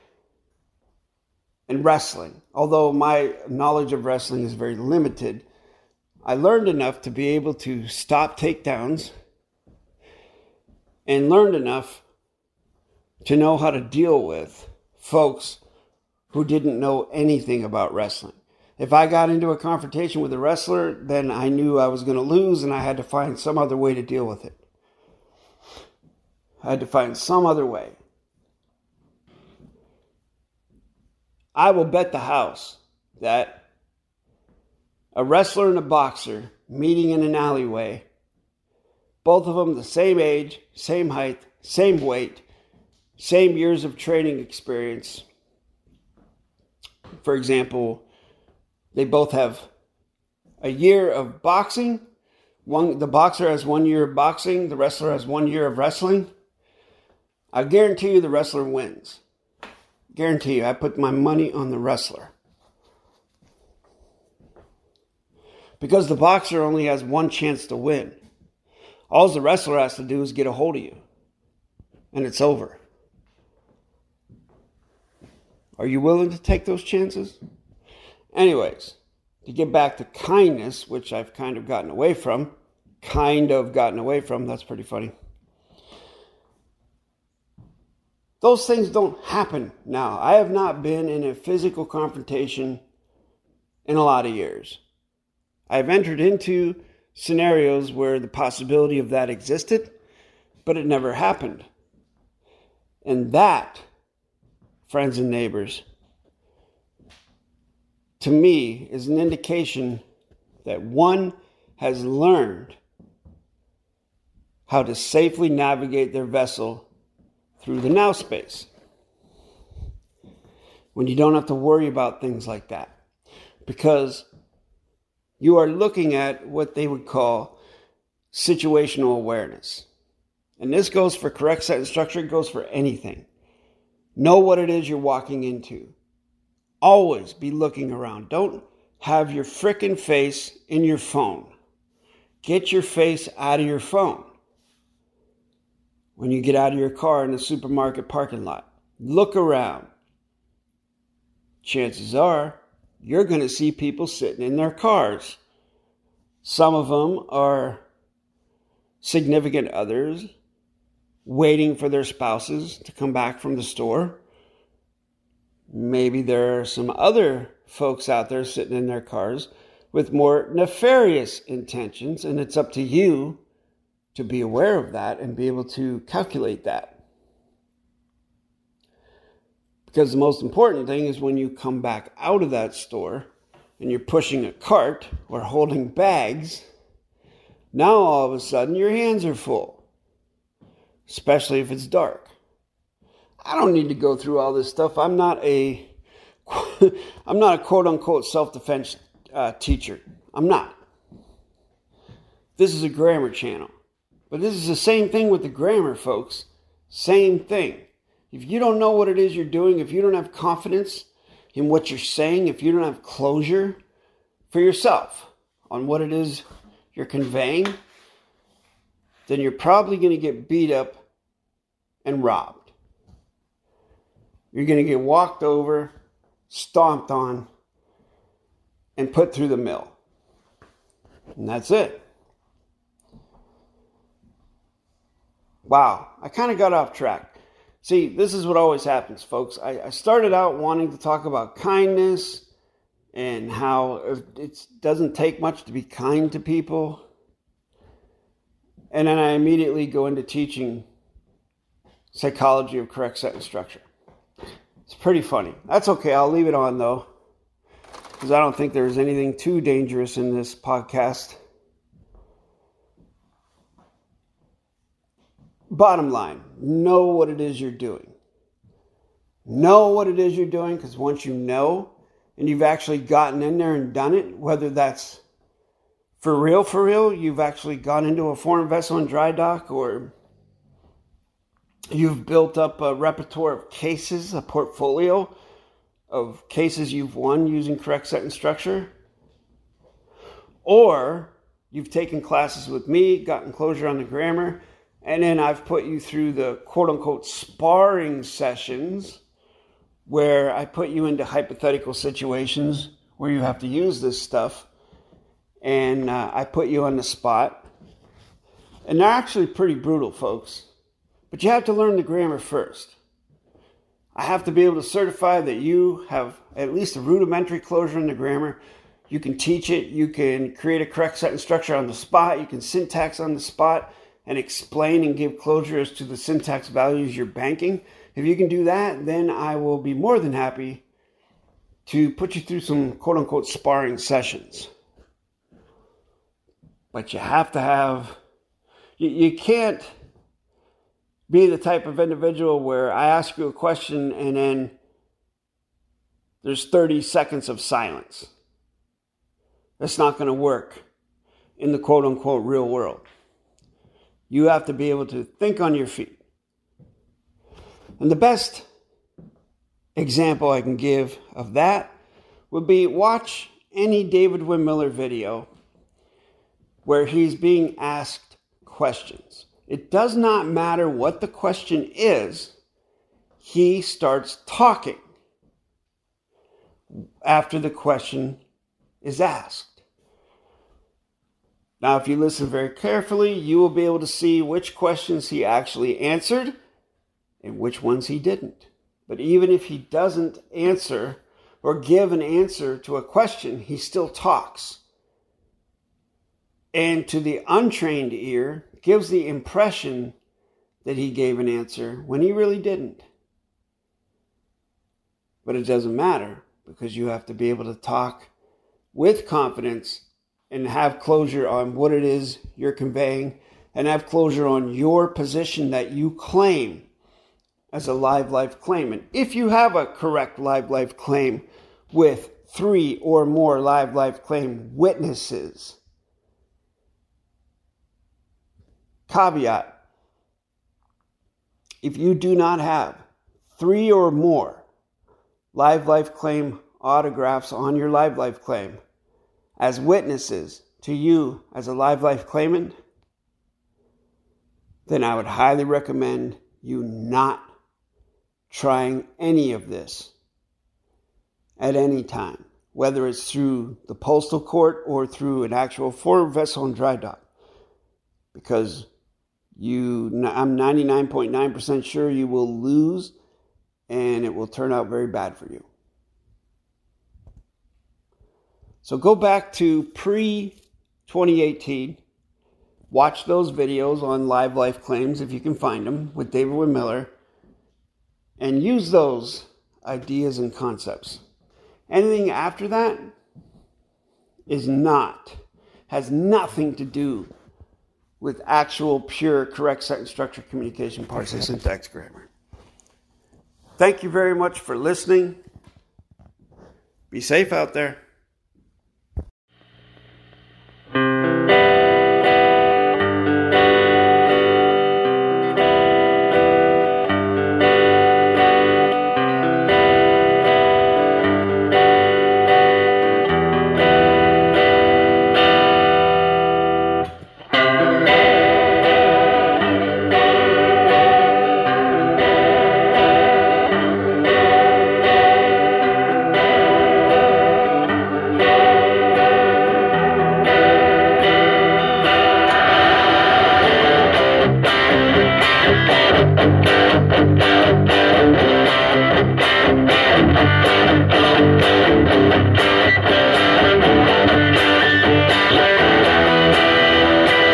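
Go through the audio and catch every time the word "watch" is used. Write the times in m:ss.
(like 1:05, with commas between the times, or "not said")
6:02, 7:52.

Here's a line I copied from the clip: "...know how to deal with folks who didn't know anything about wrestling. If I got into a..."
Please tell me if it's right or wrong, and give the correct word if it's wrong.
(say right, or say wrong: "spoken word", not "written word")
right.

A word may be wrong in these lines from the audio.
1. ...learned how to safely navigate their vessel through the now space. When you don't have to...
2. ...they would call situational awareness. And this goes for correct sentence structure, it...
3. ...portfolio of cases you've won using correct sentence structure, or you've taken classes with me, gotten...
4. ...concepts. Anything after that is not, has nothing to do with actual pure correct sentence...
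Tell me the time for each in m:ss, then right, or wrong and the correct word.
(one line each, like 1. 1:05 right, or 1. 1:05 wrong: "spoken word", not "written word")
1. 1:52 right
2. 2:06 right
3. 4:44 right
4. 8:00 right.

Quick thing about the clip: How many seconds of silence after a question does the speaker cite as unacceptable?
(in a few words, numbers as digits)
30.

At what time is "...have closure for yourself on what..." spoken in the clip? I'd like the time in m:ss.
3:32.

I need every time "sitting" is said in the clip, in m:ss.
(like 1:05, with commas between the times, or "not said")
2:34, 2:48.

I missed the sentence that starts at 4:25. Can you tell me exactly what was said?
Bottom line, know what it is you're doing.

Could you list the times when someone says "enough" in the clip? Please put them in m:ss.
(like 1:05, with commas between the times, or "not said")
0:06, 0:11.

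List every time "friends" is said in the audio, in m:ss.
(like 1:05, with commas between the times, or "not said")
1:44.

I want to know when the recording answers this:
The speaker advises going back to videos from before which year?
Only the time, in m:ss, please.
7:51.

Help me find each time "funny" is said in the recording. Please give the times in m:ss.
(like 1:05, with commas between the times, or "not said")
1:24, 4:15.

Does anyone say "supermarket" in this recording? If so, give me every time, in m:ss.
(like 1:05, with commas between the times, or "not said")
2:27.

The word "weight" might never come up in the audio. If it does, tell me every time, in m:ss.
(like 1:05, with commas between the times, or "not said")
0:42.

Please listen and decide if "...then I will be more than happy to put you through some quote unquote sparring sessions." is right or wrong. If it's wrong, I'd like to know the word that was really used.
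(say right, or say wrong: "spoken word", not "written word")
right.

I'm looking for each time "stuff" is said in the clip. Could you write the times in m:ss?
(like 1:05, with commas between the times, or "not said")
3:14, 5:04.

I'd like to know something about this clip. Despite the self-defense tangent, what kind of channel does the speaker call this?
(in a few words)
grammar channel.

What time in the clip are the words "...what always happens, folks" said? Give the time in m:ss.
3:58.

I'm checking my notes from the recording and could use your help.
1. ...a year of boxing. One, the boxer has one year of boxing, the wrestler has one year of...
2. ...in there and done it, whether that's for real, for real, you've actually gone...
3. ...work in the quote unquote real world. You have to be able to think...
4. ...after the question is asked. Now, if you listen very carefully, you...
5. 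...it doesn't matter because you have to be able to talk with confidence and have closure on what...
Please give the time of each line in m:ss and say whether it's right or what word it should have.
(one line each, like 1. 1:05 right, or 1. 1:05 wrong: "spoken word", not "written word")
1. 0:50 right
2. 4:33 right
3. 5:50 right
4. 6:17 right
5. 6:45 right.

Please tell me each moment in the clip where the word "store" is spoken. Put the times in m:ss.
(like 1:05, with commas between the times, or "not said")
2:43, 3:02.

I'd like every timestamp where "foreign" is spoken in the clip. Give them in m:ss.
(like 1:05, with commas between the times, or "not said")
4:38, 7:35.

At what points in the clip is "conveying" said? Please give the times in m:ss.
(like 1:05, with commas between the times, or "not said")
3:37, 6:52.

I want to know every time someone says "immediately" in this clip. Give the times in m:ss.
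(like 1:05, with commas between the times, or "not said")
4:09.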